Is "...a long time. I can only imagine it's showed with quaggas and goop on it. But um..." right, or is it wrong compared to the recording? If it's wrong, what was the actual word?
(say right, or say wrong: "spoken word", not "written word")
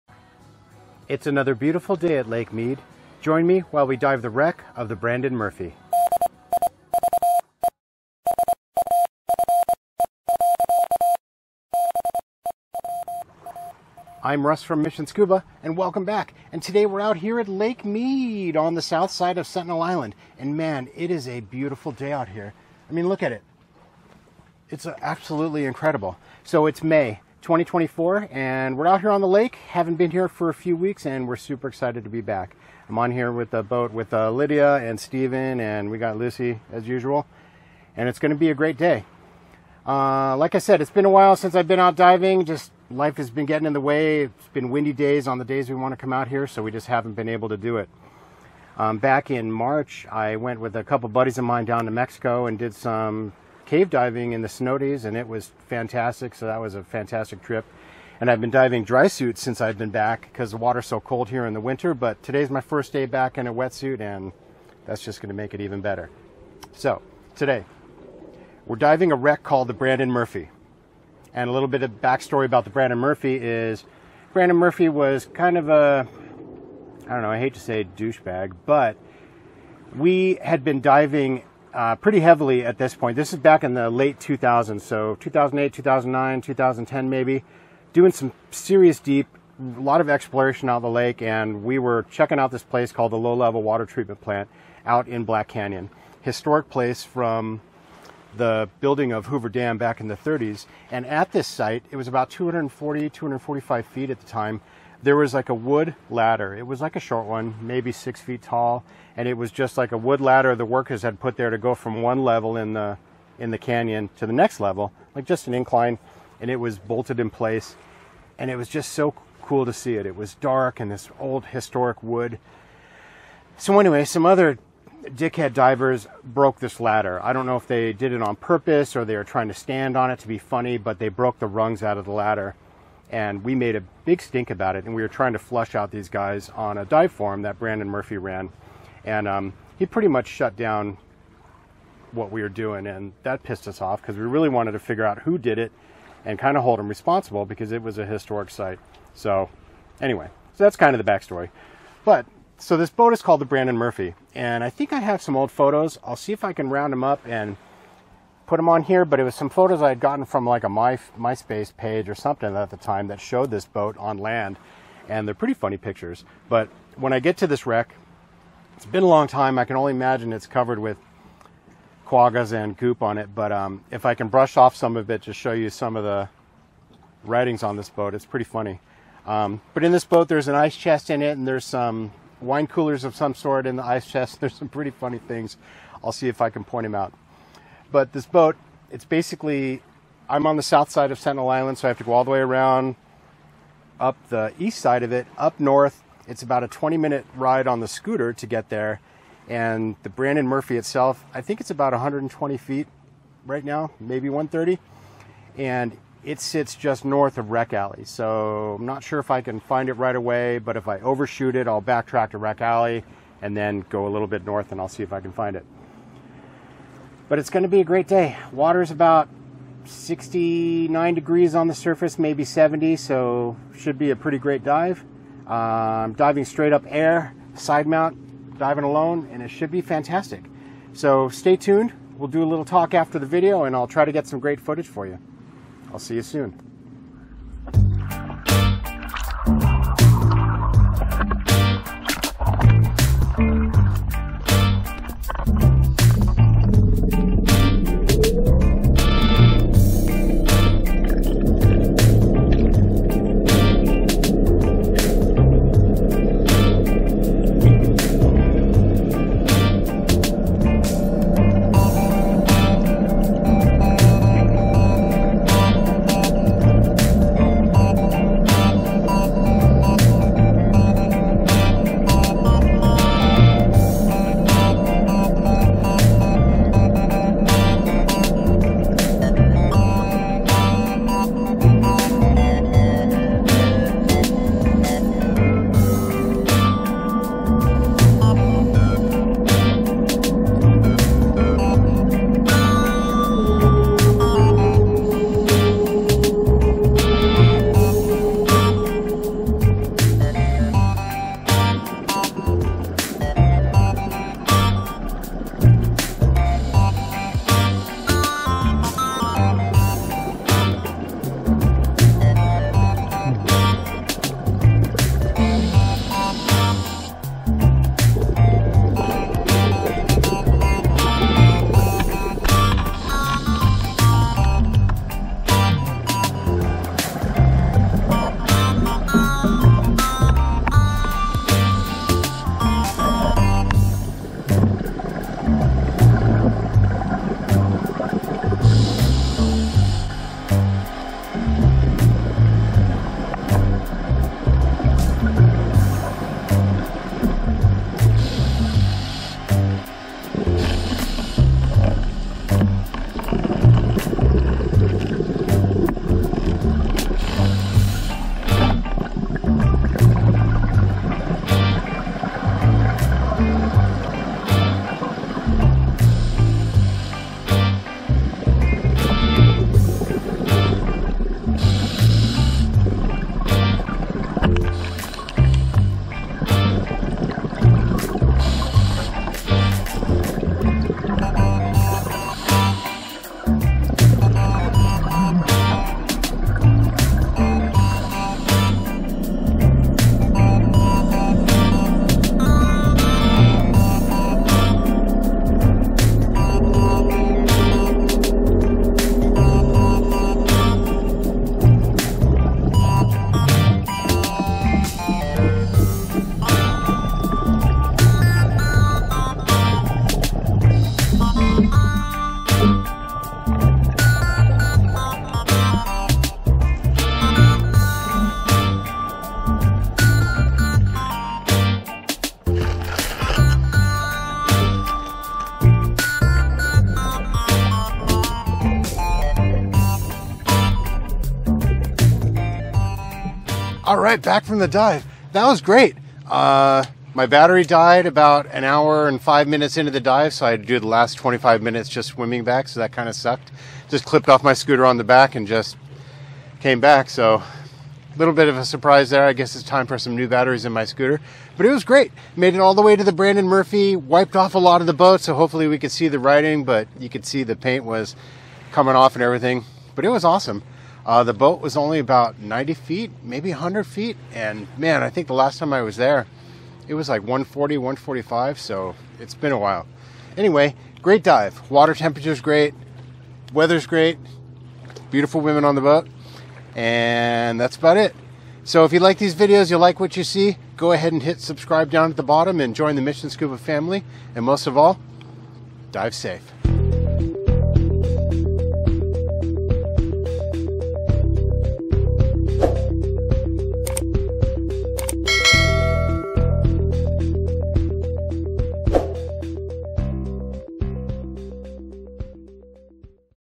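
wrong: "covered", not "showed".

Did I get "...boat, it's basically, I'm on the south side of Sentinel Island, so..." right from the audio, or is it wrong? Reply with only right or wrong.
right.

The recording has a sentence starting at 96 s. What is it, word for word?
Historic place from the building of Hoover Dam back in the 30s.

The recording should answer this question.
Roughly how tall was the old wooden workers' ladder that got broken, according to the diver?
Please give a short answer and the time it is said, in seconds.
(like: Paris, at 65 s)
6 feet, at 107 s.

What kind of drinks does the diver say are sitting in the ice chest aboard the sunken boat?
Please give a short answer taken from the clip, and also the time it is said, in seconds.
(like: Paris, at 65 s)
wine coolers, at 182 s.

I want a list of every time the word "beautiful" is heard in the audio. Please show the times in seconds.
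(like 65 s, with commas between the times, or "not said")
1 s, 21 s, 475 s.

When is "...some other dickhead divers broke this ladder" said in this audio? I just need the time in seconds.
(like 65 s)
124 s.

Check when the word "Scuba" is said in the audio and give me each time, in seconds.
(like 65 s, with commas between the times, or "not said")
15 s, 483 s.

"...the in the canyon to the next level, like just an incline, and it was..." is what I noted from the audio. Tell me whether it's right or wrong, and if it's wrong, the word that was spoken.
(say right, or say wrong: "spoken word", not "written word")
right.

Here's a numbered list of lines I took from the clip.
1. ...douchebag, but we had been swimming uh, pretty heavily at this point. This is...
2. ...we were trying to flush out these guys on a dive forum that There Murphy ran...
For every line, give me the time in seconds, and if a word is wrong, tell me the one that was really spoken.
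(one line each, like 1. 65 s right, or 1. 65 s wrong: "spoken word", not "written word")
1. 77 s wrong: "diving", not "swimming"
2. 134 s wrong: "Brandon", not "There".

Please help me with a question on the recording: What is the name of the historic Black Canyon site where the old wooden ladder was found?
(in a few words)
Low Level Water Treatment Plant.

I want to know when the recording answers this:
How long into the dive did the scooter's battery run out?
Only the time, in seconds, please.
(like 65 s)
438 s.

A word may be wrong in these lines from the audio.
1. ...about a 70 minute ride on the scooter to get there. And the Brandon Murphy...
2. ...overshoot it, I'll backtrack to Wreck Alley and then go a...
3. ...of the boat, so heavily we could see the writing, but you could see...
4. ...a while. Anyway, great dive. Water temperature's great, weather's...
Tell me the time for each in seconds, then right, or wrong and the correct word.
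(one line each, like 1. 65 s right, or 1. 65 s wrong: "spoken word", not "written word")
1. 196 s wrong: "20", not "70"
2. 210 s right
3. 454 s wrong: "hopefully", not "heavily"
4. 469 s right.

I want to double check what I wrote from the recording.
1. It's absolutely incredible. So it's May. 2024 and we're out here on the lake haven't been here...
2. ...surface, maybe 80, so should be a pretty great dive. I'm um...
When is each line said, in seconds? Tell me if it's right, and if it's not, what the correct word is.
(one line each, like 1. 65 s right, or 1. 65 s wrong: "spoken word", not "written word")
1. 24 s right
2. 221 s wrong: "70", not "80".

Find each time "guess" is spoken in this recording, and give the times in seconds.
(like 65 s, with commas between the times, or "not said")
449 s.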